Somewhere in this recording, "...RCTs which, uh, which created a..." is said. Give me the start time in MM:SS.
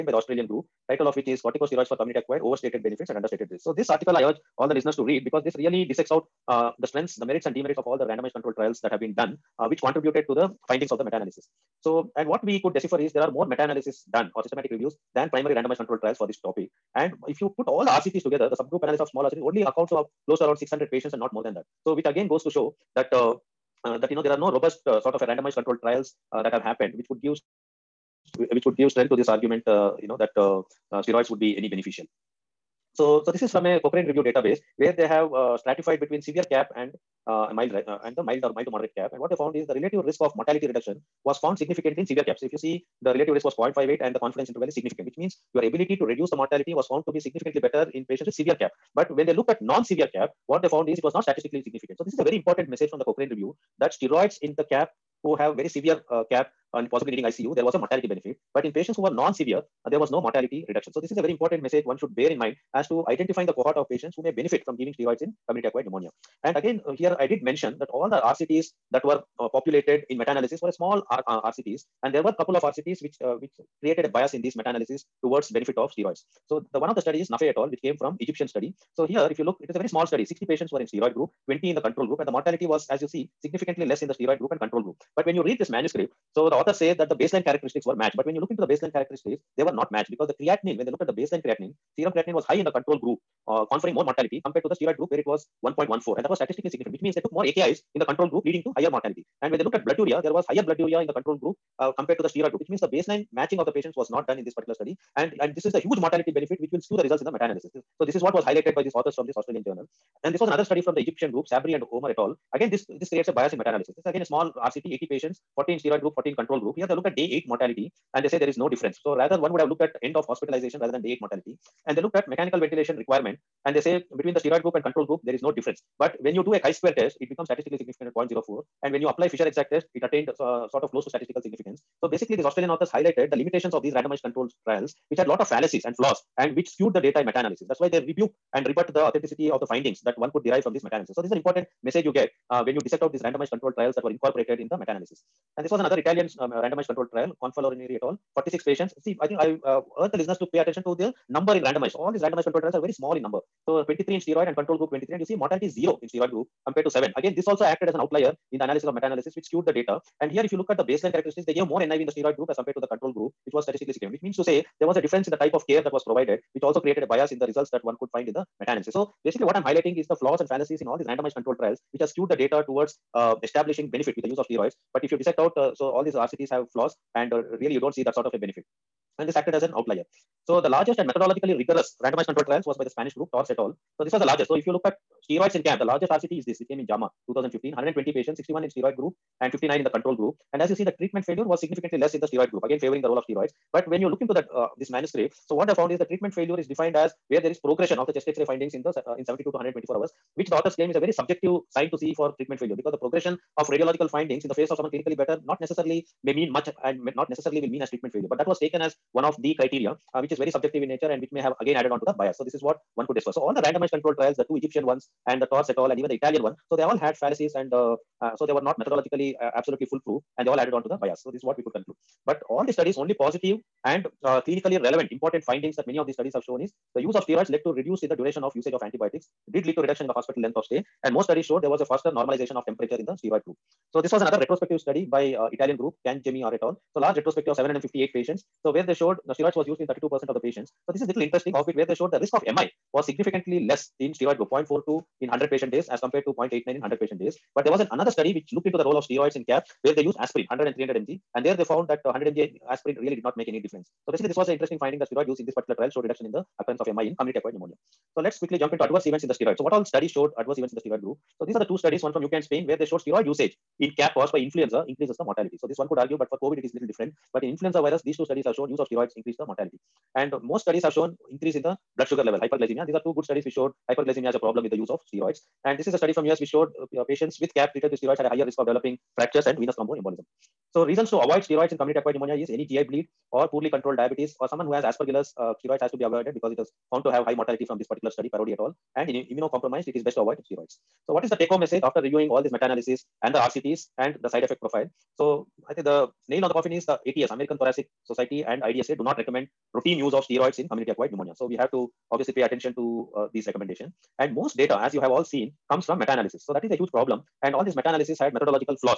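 01:12.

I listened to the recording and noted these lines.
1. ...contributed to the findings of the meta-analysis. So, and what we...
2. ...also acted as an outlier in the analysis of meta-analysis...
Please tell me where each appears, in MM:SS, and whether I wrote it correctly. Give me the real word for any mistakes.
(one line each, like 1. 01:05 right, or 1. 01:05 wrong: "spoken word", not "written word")
1. 00:09 right
2. 02:37 right.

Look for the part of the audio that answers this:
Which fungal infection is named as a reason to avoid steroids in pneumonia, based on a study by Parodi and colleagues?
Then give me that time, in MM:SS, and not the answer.
04:44.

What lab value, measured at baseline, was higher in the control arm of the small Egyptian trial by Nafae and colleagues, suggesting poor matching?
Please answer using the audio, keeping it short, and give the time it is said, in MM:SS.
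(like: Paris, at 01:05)
Serum creatinine, at 01:31.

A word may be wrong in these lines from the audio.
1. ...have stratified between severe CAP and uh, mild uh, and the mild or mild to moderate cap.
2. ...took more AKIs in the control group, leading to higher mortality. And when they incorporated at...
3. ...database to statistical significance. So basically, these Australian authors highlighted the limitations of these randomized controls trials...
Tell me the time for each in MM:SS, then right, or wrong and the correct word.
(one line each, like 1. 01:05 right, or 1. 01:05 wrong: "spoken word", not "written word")
1. 00:35 right
2. 01:37 wrong: "looked", not "incorporated"
3. 02:10 wrong: "close", not "database".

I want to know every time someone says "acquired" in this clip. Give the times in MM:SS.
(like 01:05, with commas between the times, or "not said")
00:02, 01:05, 04:17, 04:41, 05:00.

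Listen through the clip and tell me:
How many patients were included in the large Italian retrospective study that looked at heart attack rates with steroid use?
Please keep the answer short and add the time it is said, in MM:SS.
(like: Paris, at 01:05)
758, at 03:57.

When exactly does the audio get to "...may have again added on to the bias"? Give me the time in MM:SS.
03:31.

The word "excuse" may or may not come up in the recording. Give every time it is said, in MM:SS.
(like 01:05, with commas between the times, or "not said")
not said.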